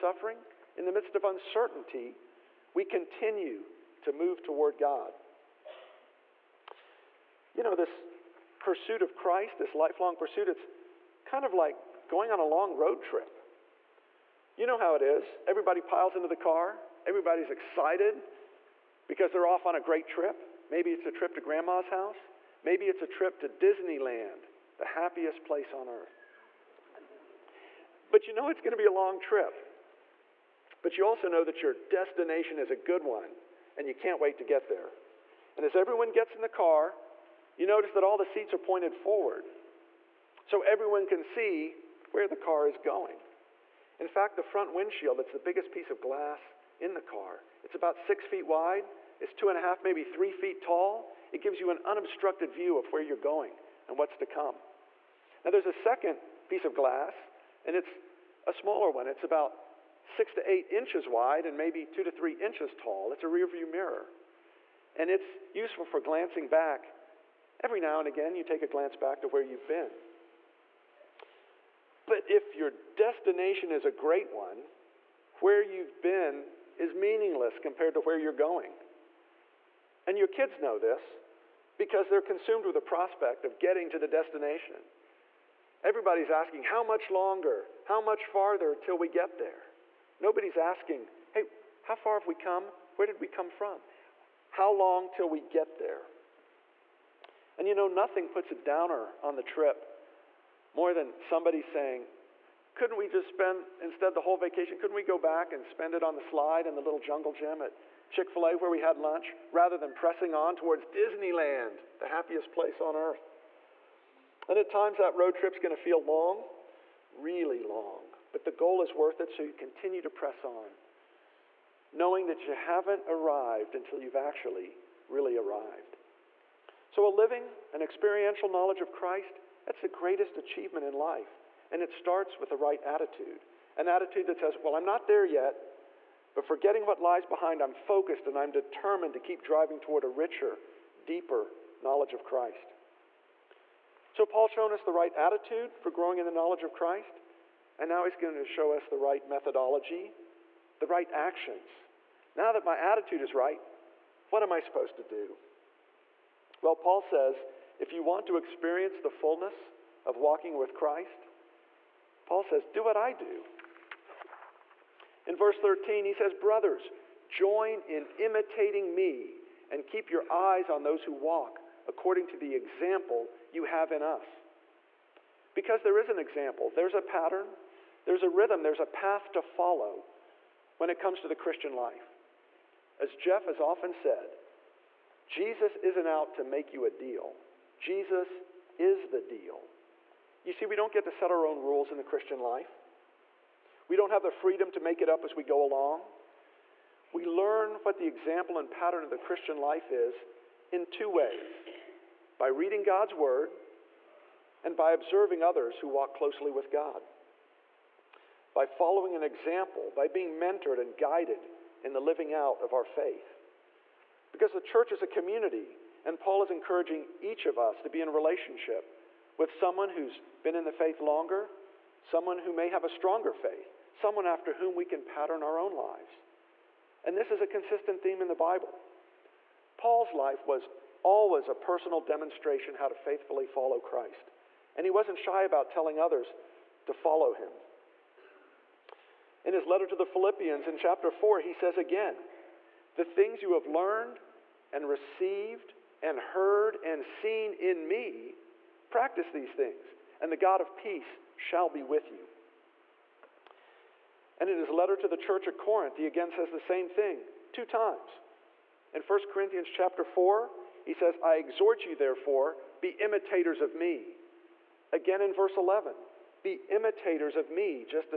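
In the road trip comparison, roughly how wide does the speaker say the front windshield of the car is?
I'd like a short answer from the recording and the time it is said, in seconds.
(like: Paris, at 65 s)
6 feet, at 47 s.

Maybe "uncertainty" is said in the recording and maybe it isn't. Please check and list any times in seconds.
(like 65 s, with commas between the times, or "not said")
1 s.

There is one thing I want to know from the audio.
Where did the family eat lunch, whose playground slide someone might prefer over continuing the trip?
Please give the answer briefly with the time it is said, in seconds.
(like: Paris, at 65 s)
Chick fil A, at 108 s.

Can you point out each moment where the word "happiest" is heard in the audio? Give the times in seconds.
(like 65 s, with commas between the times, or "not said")
24 s, 112 s.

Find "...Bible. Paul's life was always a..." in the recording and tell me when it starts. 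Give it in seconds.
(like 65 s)
228 s.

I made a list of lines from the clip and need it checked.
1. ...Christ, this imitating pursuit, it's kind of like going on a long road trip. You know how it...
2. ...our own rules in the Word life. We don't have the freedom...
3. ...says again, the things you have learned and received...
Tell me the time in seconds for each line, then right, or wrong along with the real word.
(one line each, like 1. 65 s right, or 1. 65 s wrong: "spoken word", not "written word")
1. 9 s wrong: "lifelong", not "imitating"
2. 191 s wrong: "Christian", not "Word"
3. 241 s right.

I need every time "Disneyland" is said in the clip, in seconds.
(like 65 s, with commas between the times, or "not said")
23 s, 110 s.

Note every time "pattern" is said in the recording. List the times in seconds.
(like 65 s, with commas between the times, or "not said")
177 s, 198 s, 225 s.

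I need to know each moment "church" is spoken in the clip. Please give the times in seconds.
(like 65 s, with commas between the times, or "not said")
214 s, 255 s.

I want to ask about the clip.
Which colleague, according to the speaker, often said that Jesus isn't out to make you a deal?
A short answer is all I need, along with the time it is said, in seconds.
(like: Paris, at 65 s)
Jeff, at 183 s.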